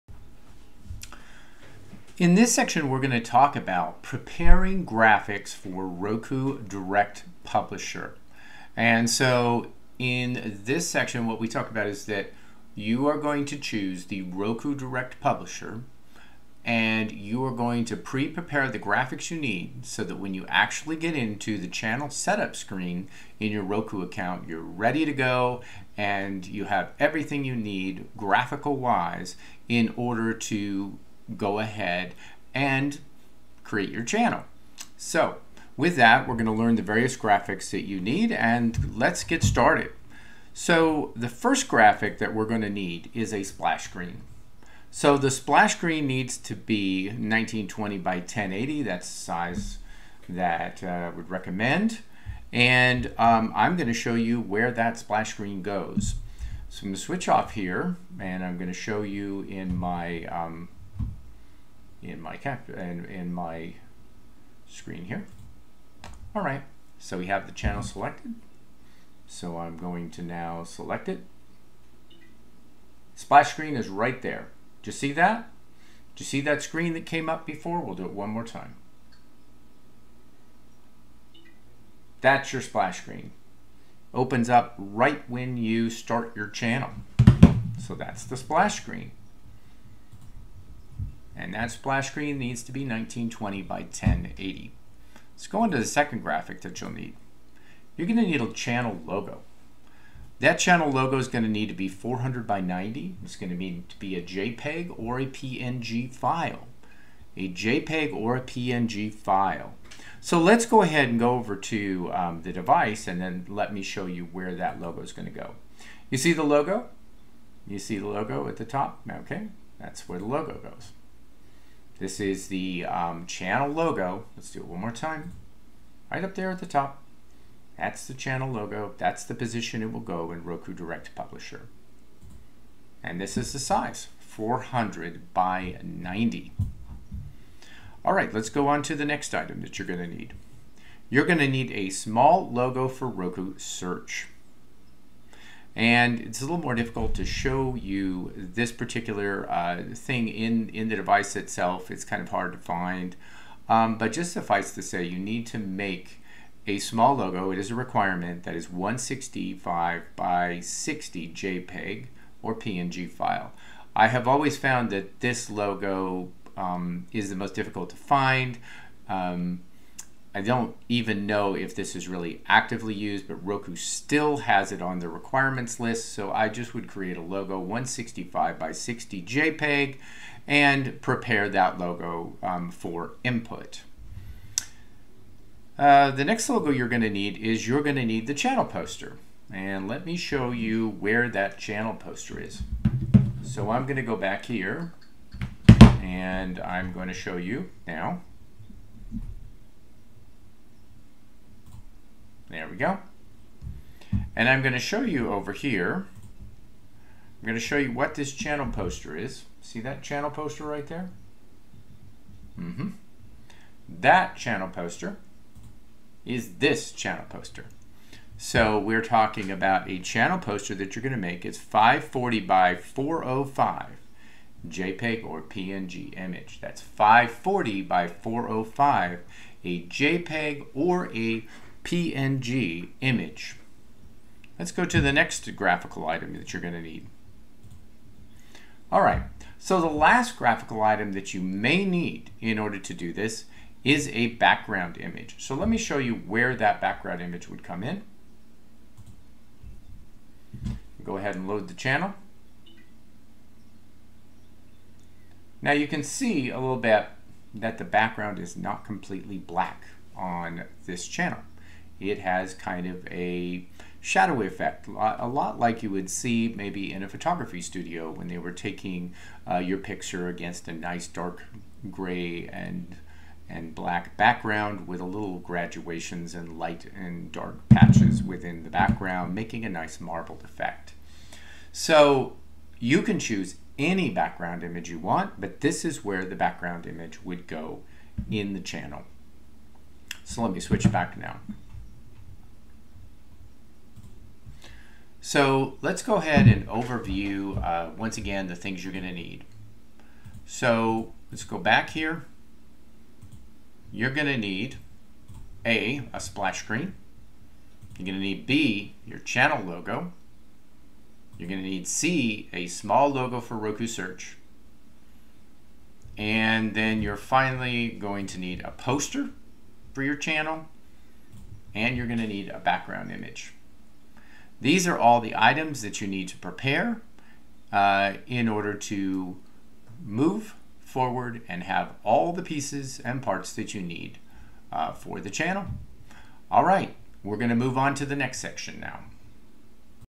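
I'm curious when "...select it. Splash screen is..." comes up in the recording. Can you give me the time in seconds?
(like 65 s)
70 s.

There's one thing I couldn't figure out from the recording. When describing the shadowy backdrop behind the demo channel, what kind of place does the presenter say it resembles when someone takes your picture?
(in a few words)
Photography studio.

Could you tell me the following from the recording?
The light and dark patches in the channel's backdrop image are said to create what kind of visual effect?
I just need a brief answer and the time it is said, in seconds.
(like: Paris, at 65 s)
Marbled effect, at 279 s.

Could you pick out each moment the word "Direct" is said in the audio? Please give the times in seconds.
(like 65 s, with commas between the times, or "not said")
6 s, 14 s, 130 s.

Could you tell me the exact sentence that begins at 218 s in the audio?
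So we're talking about a channel poster that you're going to make.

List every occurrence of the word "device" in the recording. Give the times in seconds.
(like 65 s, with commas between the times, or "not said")
112 s, 150 s.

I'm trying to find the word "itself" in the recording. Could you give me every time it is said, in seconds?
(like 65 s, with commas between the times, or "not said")
151 s.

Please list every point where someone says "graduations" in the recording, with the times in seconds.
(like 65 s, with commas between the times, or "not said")
275 s.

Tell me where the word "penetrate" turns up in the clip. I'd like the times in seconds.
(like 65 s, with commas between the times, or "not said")
not said.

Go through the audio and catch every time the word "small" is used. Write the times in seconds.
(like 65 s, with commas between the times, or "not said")
141 s, 156 s, 312 s.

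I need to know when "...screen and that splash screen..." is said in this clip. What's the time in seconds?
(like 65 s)
88 s.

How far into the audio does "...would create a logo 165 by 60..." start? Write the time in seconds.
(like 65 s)
176 s.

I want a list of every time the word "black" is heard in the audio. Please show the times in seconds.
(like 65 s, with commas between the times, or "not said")
259 s, 273 s.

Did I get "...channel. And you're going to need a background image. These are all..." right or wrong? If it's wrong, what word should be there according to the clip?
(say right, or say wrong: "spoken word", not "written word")
right.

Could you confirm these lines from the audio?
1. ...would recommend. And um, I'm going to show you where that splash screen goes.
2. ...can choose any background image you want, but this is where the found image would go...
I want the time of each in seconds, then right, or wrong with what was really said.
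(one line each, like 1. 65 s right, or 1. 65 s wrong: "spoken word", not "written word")
1. 51 s right
2. 283 s wrong: "background", not "found".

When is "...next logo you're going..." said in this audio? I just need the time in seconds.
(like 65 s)
186 s.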